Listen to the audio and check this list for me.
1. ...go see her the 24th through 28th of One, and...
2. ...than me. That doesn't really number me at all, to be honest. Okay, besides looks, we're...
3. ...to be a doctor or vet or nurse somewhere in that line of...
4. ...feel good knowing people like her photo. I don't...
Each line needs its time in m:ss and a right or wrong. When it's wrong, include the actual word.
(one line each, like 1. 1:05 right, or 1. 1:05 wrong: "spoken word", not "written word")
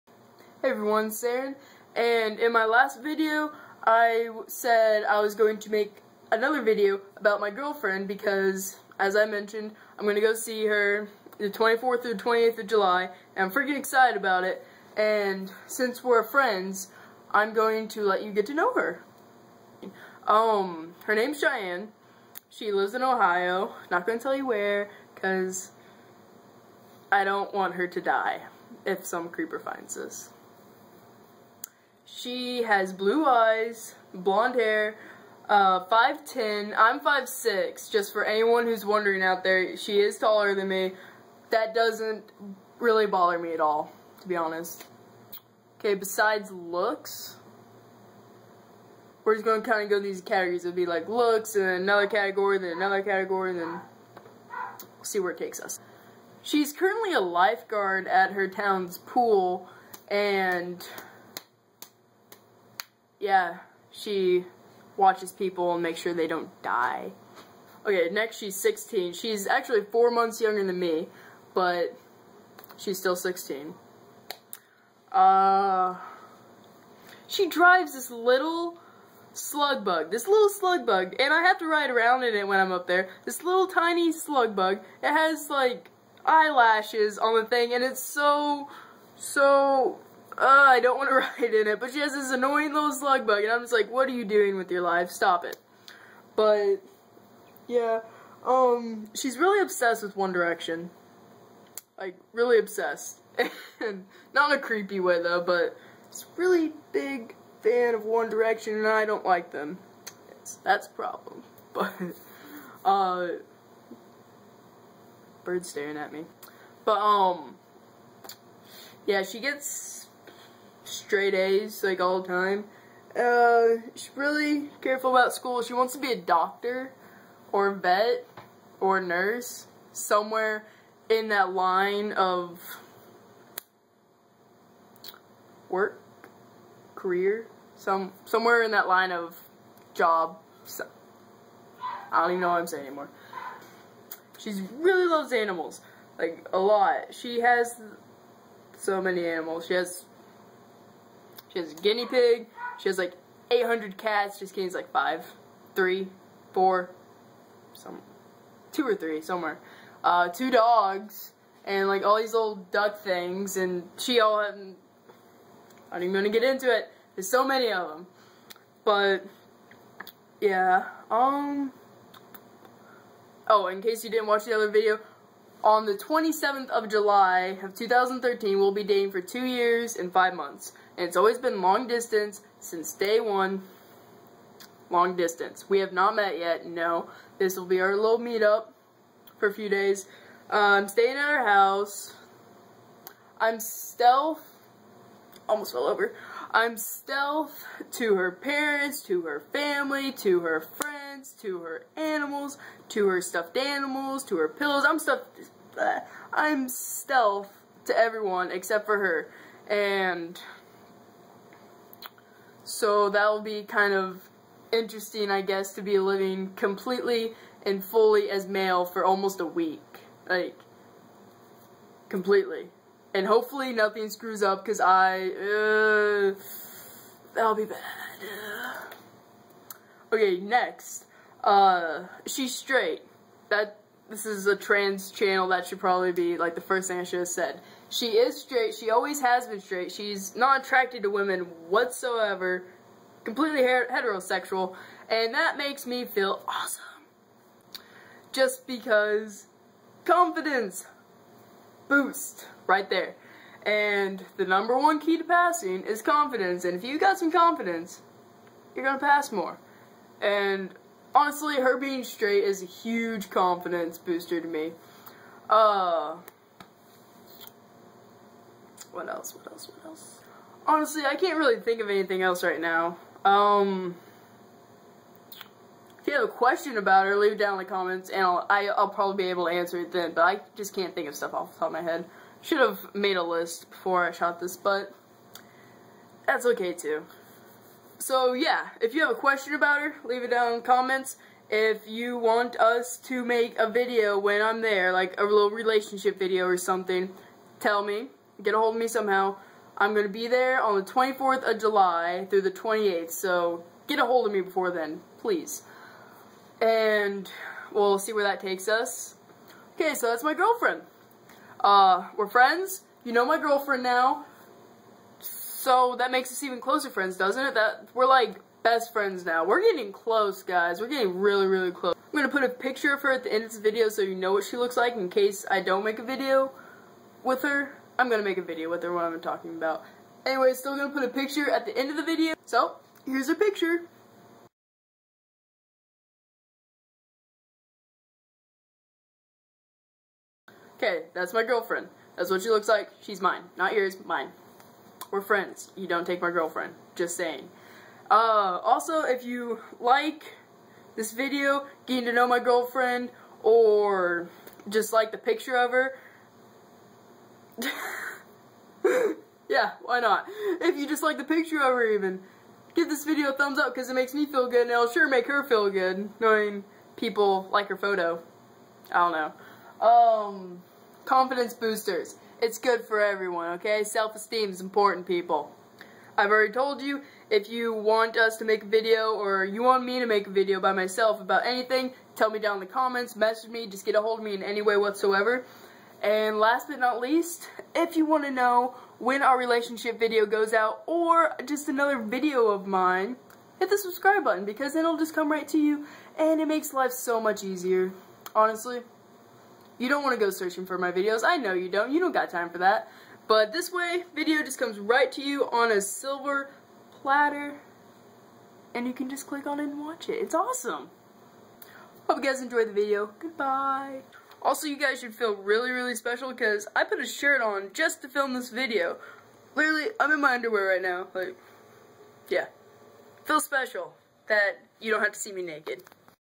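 1. 0:10 wrong: "July", not "One"
2. 0:40 wrong: "bother", not "number"
3. 2:05 right
4. 6:05 right.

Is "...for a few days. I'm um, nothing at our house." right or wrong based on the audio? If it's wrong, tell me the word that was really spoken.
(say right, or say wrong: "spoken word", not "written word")
wrong: "staying", not "nothing".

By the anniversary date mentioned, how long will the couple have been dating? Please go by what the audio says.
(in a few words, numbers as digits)
2 years and 5 months.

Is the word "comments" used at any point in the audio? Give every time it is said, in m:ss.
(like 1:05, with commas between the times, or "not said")
4:37, 4:50, 6:22.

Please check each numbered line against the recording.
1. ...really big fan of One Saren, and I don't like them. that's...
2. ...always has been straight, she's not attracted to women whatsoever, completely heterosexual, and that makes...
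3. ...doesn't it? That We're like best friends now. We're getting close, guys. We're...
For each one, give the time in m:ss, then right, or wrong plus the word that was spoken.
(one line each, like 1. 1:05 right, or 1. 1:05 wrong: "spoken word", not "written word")
1. 1:46 wrong: "Direction", not "Saren"
2. 3:58 right
3. 5:17 right.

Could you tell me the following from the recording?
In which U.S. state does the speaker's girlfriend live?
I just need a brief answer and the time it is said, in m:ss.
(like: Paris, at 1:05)
Ohio, at 0:23.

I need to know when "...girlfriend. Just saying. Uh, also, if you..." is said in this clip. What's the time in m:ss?
5:46.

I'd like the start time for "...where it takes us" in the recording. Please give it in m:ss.
0:55.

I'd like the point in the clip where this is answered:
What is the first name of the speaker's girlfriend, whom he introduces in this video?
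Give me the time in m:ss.
0:21.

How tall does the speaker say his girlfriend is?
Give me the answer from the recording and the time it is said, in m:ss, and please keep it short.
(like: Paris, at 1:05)
5'10", at 0:35.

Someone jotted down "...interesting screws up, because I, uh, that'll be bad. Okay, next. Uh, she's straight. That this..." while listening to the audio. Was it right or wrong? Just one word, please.
wrong.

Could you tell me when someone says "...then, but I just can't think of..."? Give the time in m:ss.
4:39.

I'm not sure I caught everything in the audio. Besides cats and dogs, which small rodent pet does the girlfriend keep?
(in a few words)
Guinea pig.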